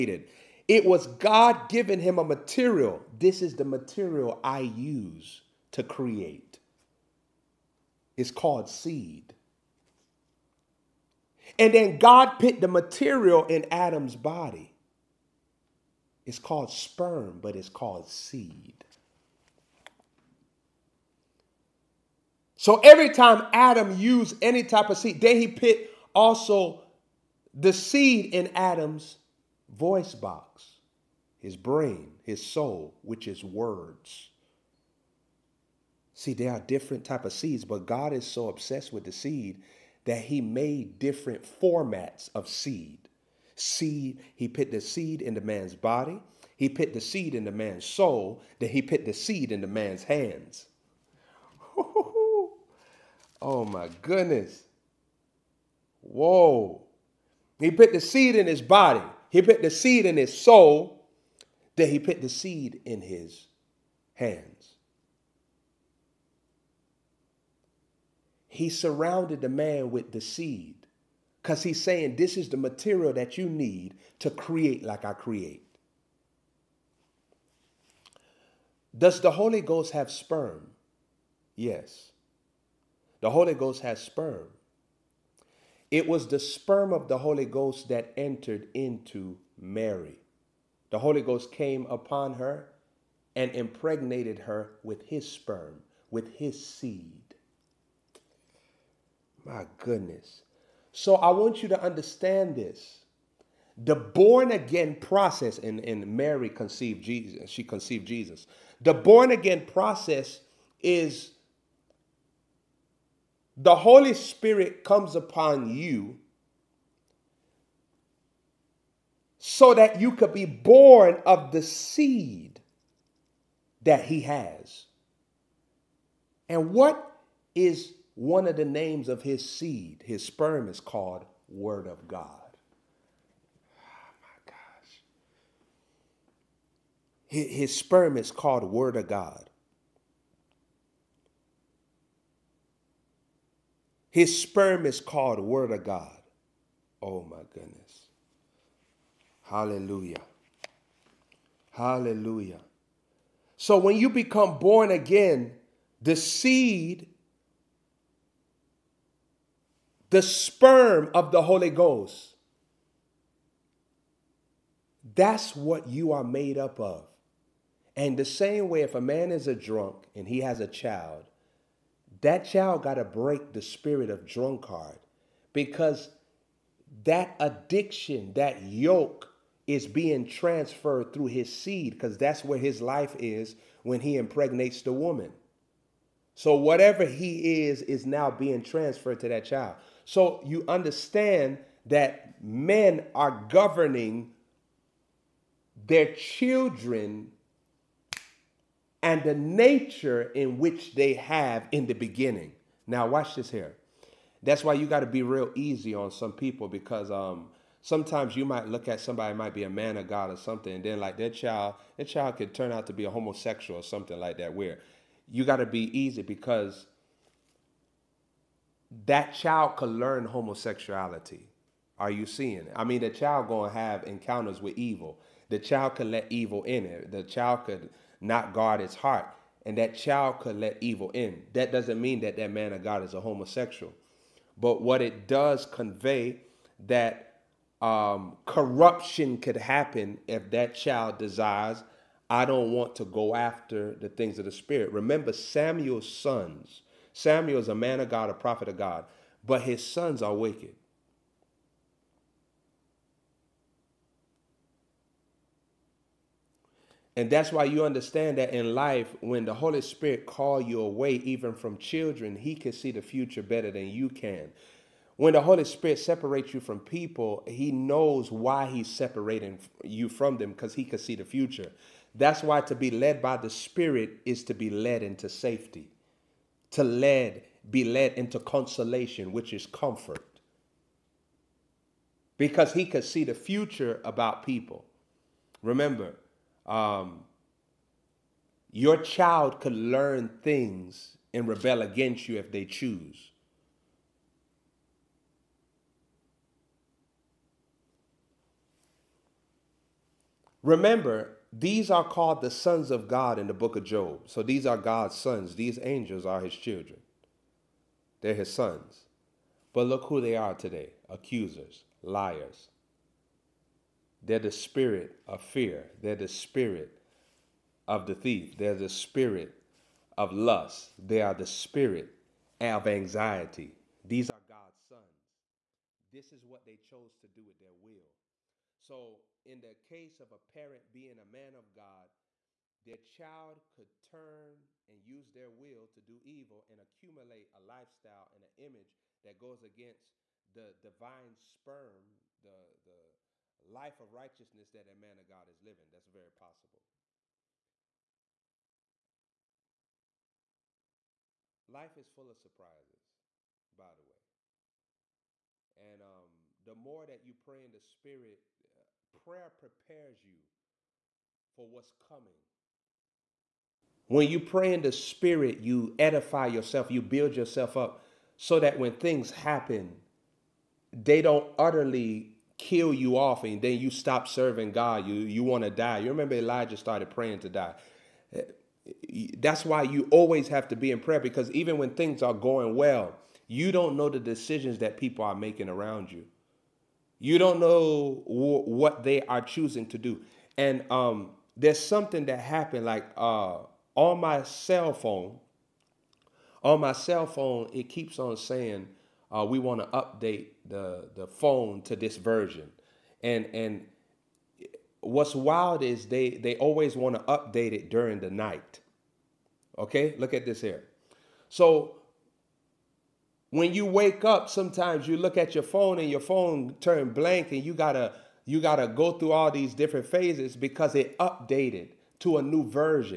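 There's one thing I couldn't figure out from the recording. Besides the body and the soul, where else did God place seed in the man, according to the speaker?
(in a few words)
his hands.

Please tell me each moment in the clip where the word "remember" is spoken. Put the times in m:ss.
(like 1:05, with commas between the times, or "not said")
4:04, 4:45, 5:00, 6:16.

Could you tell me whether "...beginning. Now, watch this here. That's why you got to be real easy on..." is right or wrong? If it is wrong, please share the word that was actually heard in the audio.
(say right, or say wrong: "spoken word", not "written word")
right.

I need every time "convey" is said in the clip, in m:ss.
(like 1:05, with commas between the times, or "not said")
3:55.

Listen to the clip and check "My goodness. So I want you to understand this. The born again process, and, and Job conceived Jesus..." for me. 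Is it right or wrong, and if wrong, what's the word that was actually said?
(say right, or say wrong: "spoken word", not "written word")
wrong: "Mary", not "Job".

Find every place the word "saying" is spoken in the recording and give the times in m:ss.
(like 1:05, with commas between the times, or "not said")
1:11, 6:38.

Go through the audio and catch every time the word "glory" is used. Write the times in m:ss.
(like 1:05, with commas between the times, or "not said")
not said.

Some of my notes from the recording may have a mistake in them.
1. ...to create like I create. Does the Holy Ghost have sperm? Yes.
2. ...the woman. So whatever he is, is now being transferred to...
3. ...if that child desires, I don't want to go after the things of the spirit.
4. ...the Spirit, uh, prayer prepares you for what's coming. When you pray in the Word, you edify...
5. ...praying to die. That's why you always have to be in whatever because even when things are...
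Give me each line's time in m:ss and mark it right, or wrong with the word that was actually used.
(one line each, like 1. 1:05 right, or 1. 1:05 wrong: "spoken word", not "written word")
1. 1:14 right
2. 3:04 right
3. 4:00 right
4. 5:57 wrong: "Spirit", not "Word"
5. 6:17 wrong: "prayer", not "whatever".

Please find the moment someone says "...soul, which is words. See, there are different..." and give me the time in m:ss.
0:32.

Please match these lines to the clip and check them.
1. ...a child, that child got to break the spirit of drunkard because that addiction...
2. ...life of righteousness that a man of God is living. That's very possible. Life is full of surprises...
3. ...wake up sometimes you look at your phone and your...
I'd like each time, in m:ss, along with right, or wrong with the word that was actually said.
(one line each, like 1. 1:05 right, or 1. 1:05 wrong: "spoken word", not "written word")
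1. 2:50 right
2. 5:43 right
3. 6:53 right.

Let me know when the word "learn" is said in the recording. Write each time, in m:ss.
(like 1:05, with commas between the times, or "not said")
3:39, 4:49.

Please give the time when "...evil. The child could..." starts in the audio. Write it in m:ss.
3:44.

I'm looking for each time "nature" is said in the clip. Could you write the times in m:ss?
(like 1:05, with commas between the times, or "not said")
3:19.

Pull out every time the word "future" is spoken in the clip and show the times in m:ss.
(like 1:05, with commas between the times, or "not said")
4:23, 4:31, 4:43.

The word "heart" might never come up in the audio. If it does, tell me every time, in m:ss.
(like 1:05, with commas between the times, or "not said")
3:48.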